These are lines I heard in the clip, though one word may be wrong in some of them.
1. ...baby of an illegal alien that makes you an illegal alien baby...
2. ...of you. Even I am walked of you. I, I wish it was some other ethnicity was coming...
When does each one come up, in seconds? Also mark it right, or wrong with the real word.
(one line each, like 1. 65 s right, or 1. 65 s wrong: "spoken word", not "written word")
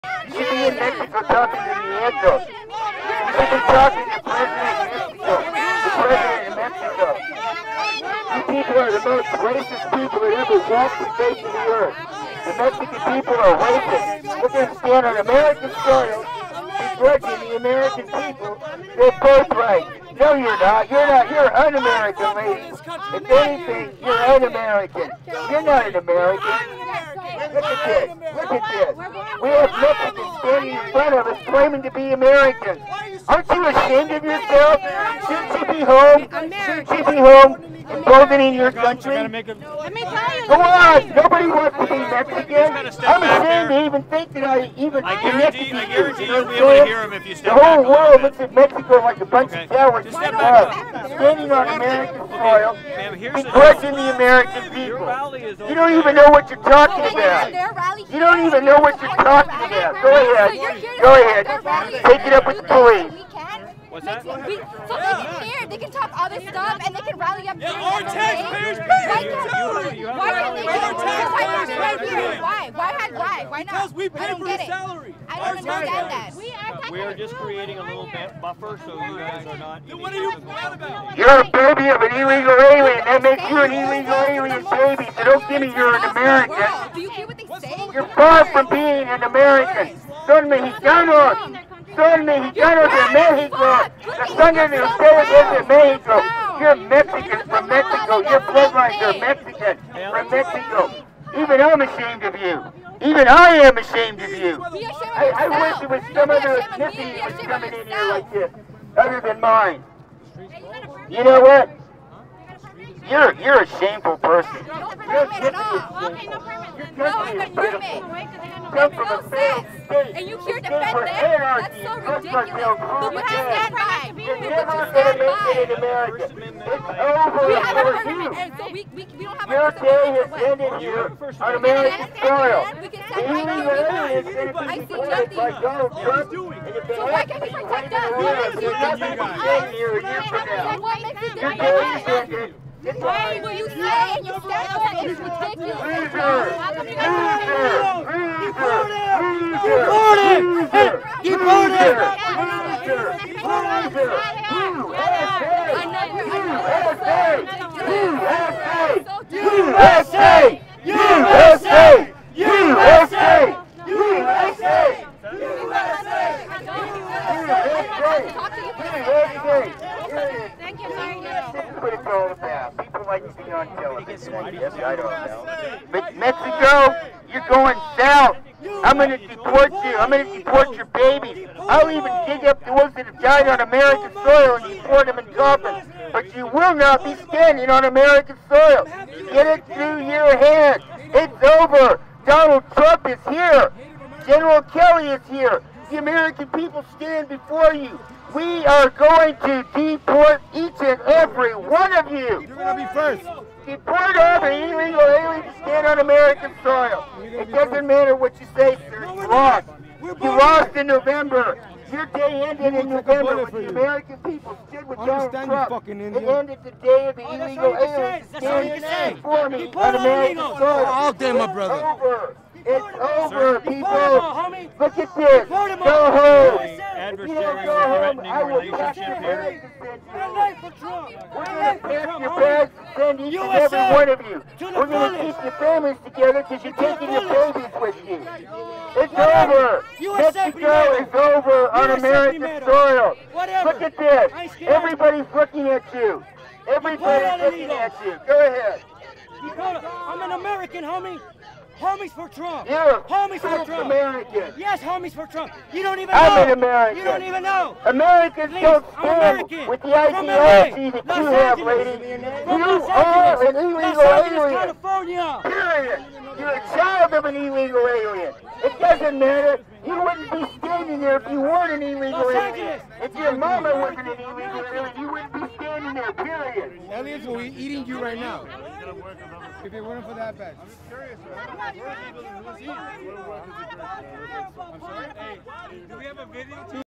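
1. 81 s right
2. 102 s wrong: "ashamed", not "walked".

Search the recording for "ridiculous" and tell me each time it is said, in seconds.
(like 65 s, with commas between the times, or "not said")
121 s, 144 s.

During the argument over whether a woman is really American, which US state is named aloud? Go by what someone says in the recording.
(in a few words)
California.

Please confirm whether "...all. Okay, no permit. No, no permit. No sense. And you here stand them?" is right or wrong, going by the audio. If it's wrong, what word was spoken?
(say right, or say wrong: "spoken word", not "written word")
wrong: "defend", not "stand".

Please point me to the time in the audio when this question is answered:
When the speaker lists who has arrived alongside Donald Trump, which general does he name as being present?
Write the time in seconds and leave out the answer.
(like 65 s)
194 s.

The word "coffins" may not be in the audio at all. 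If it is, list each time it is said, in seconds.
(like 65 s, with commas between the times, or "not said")
185 s.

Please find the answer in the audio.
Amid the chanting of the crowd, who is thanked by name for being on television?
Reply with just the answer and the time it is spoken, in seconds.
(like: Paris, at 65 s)
Mario, at 170 s.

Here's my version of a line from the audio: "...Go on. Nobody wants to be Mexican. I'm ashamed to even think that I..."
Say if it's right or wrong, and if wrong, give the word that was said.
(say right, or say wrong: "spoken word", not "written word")
right.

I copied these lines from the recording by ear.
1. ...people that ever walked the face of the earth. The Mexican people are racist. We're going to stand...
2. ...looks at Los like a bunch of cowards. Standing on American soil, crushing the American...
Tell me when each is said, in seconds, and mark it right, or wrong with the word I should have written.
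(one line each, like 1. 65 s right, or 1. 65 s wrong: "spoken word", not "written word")
1. 9 s right
2. 48 s wrong: "Mexico", not "Los".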